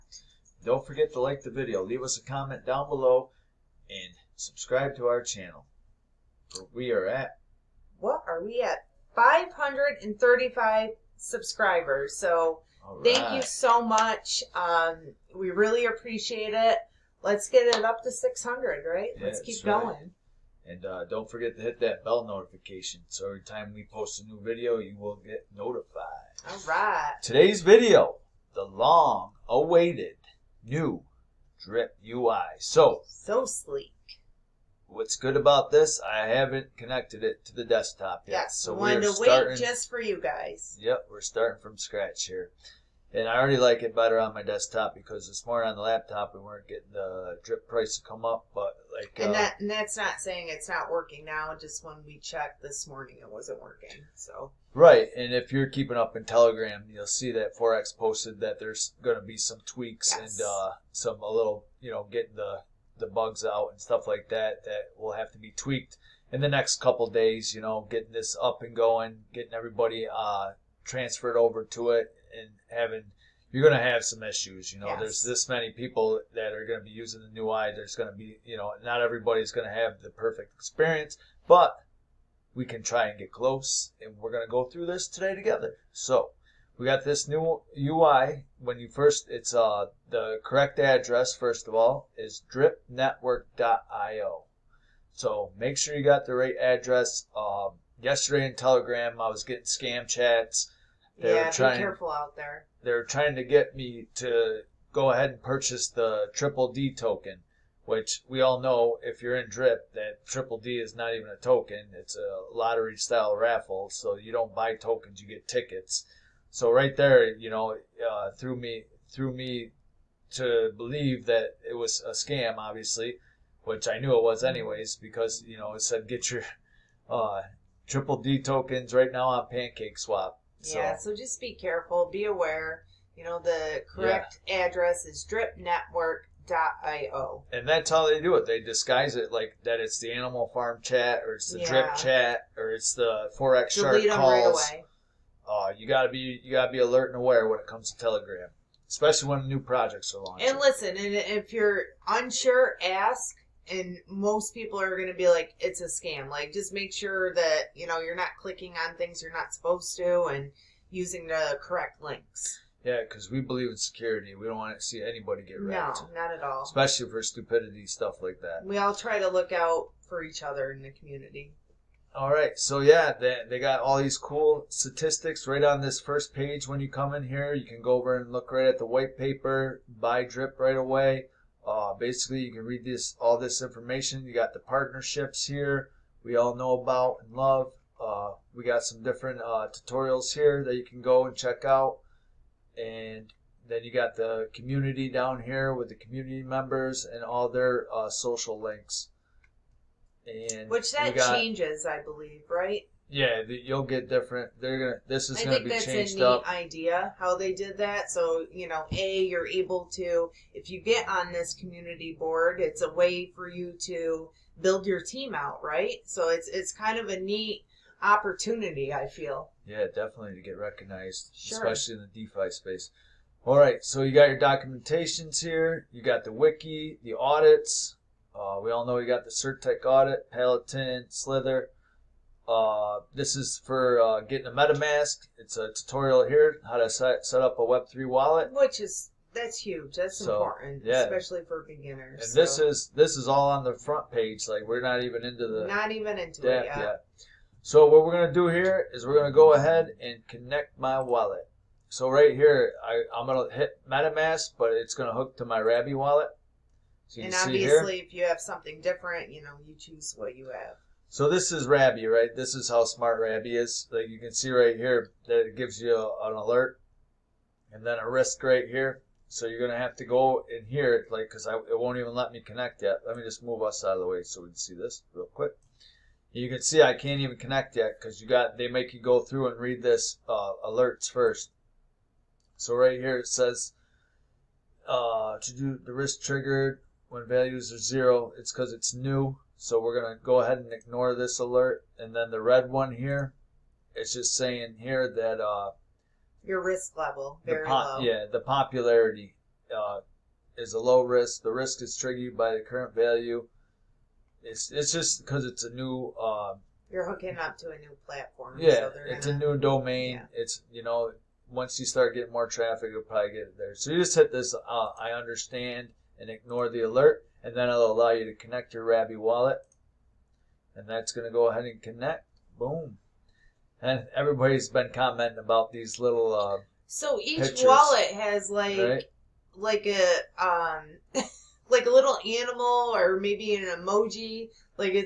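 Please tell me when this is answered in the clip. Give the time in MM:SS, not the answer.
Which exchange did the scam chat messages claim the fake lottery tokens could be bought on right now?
02:09.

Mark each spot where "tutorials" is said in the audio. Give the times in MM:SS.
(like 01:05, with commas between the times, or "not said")
03:09, 03:55.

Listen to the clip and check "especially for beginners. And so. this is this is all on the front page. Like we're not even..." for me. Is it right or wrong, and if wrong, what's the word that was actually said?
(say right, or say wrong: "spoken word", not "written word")
right.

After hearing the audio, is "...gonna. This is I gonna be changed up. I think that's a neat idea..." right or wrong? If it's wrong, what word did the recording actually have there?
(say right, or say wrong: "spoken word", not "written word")
right.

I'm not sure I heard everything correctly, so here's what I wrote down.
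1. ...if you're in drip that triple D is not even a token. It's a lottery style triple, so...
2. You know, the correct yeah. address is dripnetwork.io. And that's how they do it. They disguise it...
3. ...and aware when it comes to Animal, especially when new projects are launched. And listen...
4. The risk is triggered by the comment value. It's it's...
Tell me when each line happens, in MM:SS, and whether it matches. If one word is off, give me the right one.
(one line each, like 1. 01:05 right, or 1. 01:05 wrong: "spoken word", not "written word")
1. 01:49 wrong: "raffle", not "triple"
2. 02:13 right
3. 02:27 wrong: "Telegram", not "Animal"
4. 05:01 wrong: "current", not "comment".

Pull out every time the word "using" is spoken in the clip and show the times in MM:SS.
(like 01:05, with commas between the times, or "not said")
01:16, 02:40.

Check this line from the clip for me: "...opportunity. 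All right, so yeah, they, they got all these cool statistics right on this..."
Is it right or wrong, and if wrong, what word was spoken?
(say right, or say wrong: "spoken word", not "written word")
wrong: "community", not "opportunity".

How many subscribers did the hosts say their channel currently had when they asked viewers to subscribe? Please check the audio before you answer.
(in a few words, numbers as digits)
535.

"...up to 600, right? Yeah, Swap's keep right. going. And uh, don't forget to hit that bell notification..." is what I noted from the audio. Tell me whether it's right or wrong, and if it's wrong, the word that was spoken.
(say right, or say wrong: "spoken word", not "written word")
wrong: "Let", not "Swap".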